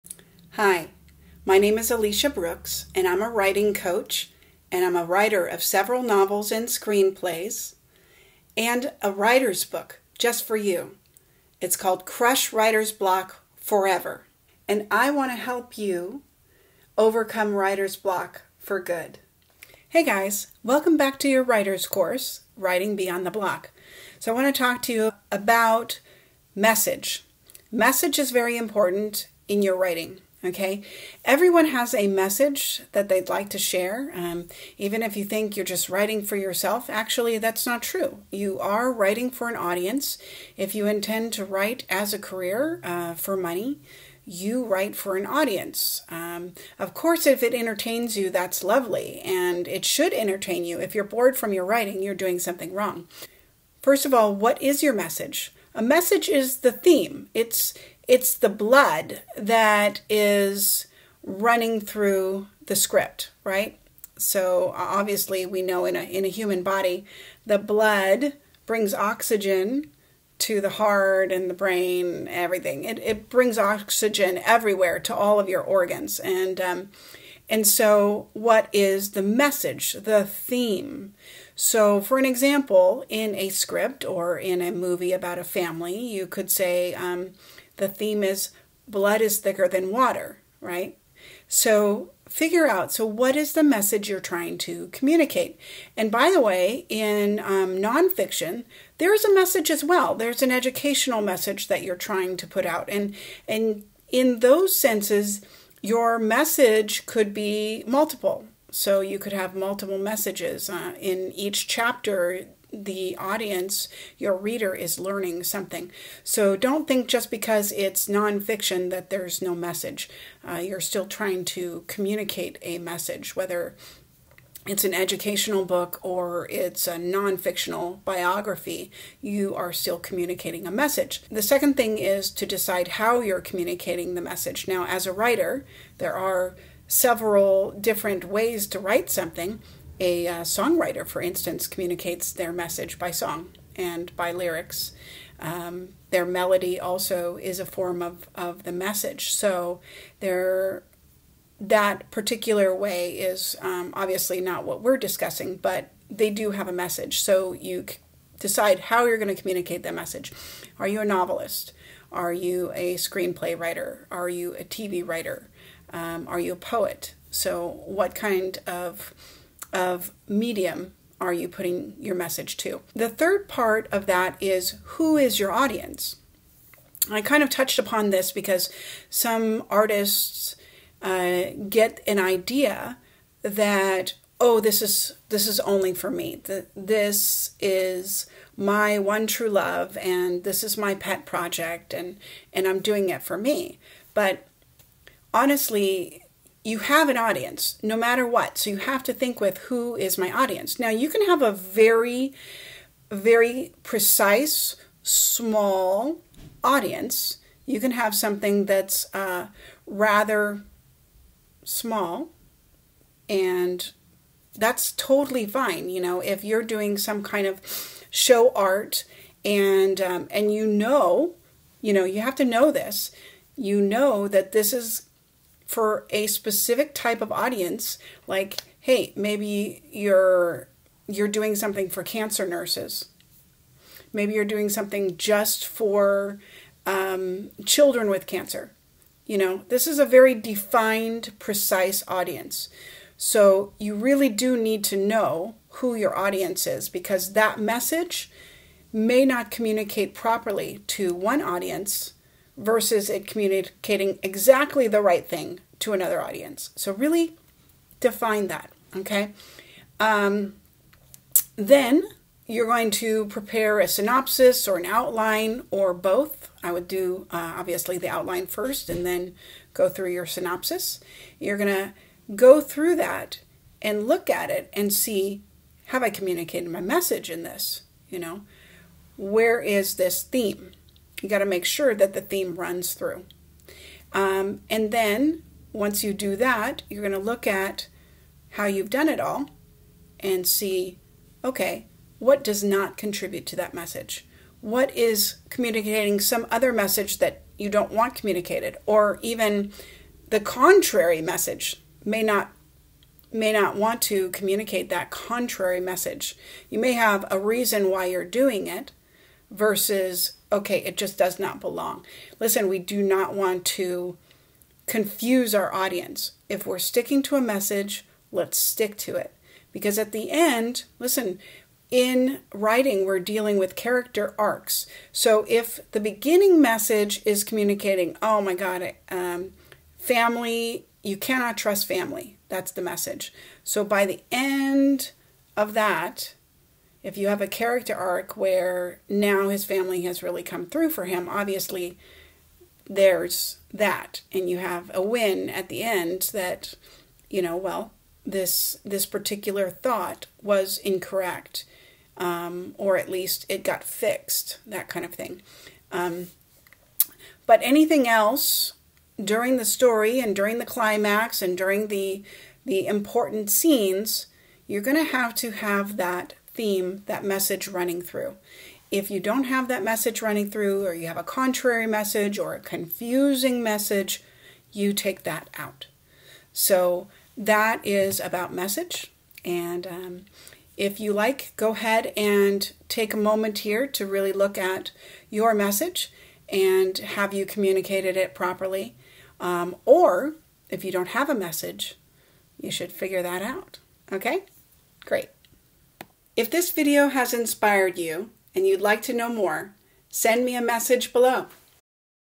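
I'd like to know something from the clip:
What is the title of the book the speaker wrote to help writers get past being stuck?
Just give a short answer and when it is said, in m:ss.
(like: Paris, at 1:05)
Crush Writer's Block Forever, at 0:12.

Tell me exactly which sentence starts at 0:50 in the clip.
If you're bored from your writing, you're doing something wrong.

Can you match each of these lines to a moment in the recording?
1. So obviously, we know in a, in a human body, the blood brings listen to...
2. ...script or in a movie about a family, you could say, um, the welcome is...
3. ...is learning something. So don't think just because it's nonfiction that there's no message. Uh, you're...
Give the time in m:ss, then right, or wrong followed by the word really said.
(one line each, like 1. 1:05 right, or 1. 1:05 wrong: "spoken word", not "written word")
1. 1:04 wrong: "oxygen", not "listen"
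2. 1:23 wrong: "theme", not "welcome"
3. 1:54 right.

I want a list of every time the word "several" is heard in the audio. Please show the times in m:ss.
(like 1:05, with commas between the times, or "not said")
0:05, 2:16.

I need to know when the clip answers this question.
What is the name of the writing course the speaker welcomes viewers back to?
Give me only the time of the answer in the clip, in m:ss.
0:22.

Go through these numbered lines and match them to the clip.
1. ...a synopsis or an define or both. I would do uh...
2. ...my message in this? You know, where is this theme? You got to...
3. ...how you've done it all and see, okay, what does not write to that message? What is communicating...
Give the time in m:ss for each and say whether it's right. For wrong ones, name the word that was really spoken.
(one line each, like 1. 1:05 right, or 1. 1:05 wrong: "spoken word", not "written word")
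1. 4:23 wrong: "outline", not "define"
2. 4:36 right
3. 4:48 wrong: "contribute", not "write".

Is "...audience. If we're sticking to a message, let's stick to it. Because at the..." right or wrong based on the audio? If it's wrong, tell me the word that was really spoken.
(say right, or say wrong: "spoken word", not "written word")
right.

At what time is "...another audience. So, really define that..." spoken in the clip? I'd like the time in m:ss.
4:15.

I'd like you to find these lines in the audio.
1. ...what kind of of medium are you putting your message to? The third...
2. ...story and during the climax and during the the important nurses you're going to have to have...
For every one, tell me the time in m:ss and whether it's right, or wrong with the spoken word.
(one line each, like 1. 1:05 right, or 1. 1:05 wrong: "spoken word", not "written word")
1. 2:47 right
2. 5:59 wrong: "scenes", not "nurses".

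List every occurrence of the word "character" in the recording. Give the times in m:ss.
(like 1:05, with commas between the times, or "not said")
5:23, 5:37.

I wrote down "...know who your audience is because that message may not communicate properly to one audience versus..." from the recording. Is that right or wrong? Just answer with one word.
right.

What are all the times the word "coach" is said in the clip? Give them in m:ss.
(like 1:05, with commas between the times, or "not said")
0:03.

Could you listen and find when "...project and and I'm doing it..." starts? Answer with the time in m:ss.
3:11.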